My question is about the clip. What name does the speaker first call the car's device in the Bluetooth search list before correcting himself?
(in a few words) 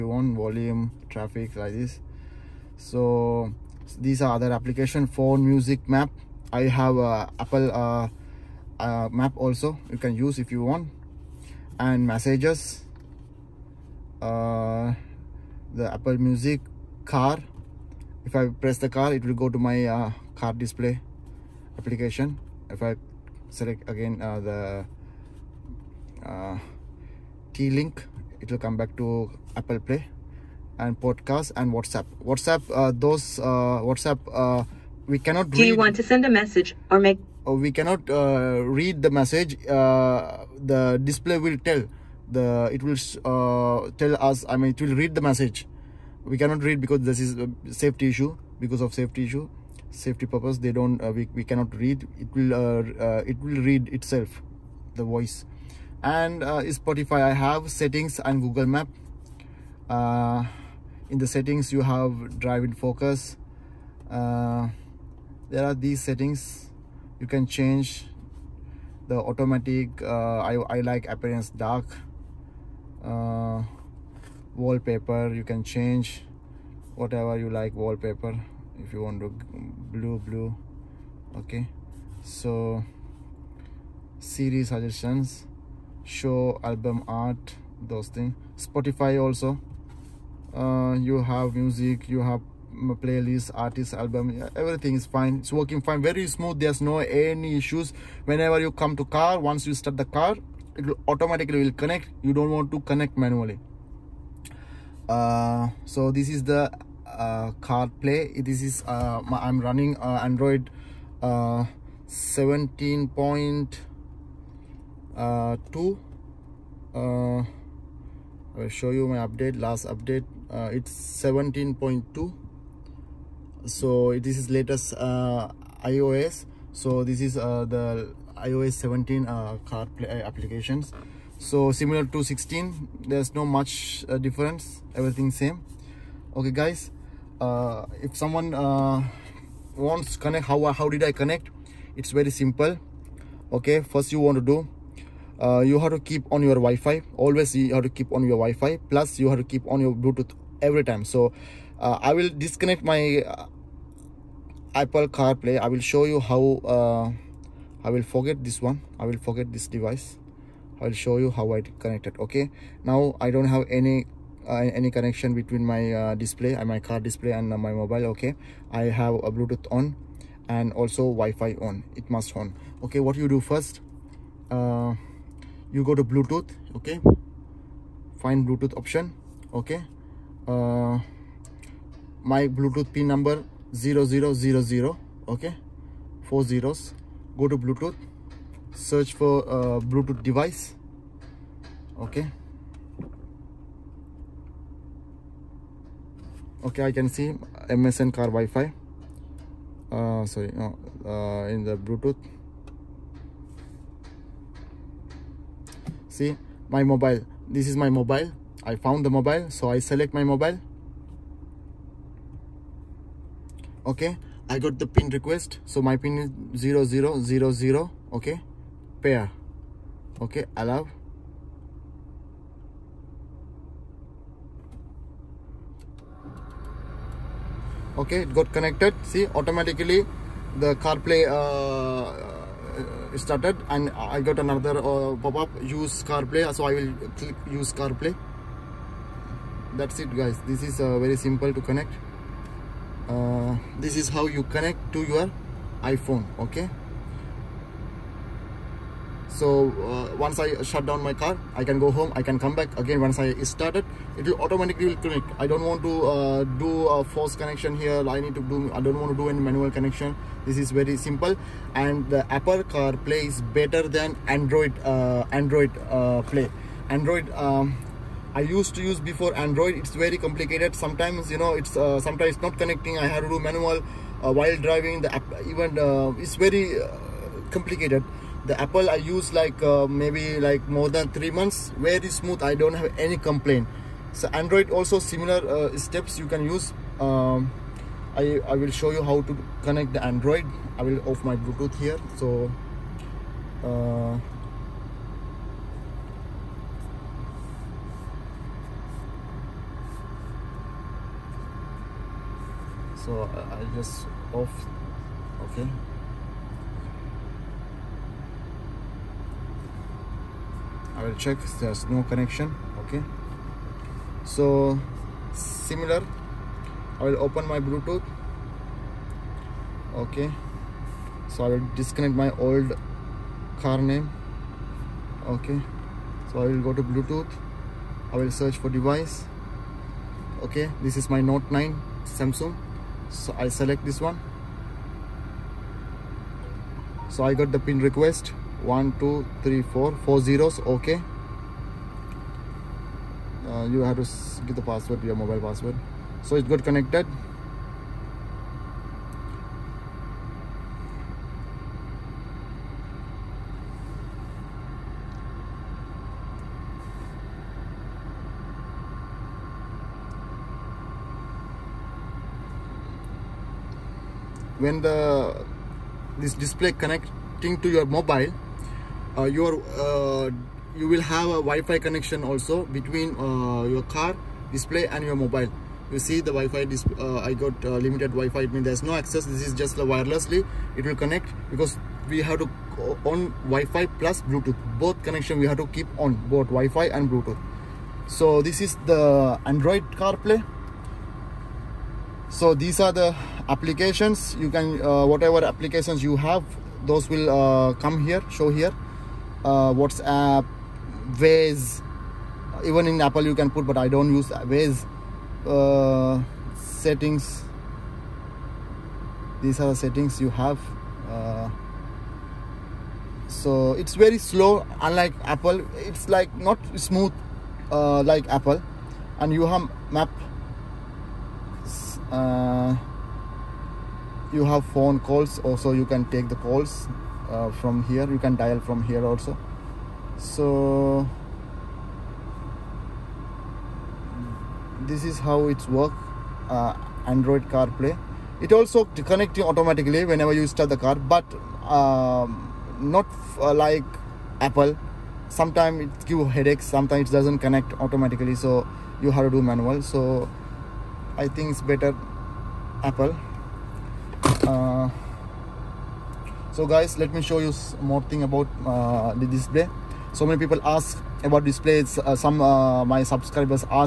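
MSN car wi-fi.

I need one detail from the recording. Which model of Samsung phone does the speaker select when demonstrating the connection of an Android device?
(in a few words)
Note 9.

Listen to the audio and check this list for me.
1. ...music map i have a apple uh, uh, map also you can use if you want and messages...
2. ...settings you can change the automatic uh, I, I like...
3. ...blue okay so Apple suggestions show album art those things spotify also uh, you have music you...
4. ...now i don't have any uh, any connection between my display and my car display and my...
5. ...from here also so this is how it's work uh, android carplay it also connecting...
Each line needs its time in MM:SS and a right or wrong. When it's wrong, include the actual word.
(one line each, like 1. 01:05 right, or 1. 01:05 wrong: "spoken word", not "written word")
1. 00:05 right
2. 01:06 right
3. 01:20 wrong: "Siri", not "Apple"
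4. 02:42 right
5. 07:08 right.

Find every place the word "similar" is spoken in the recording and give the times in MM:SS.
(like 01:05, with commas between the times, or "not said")
02:11, 04:44, 05:15.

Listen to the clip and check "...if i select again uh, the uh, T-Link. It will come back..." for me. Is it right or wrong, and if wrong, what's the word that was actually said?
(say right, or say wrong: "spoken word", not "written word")
right.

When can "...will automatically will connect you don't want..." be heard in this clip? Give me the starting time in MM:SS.
01:40.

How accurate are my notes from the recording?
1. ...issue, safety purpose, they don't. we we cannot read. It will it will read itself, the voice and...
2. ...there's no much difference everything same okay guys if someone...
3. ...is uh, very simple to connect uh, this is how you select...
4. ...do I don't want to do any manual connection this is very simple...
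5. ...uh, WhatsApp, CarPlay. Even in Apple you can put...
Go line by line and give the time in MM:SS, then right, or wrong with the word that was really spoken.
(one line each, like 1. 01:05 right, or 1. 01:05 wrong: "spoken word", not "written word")
1. 00:49 right
2. 02:13 right
3. 04:00 wrong: "connect", not "select"
4. 04:18 right
5. 06:39 wrong: "Waze", not "CarPlay".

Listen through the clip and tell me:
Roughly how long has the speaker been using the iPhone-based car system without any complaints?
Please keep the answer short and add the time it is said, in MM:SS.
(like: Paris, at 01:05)
more than three months, at 04:40.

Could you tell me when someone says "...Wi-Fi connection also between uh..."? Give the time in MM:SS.
06:11.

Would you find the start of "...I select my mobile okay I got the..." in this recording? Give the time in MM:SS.
03:29.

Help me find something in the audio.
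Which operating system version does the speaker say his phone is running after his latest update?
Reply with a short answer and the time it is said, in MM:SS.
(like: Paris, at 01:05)
17.2, at 02:00.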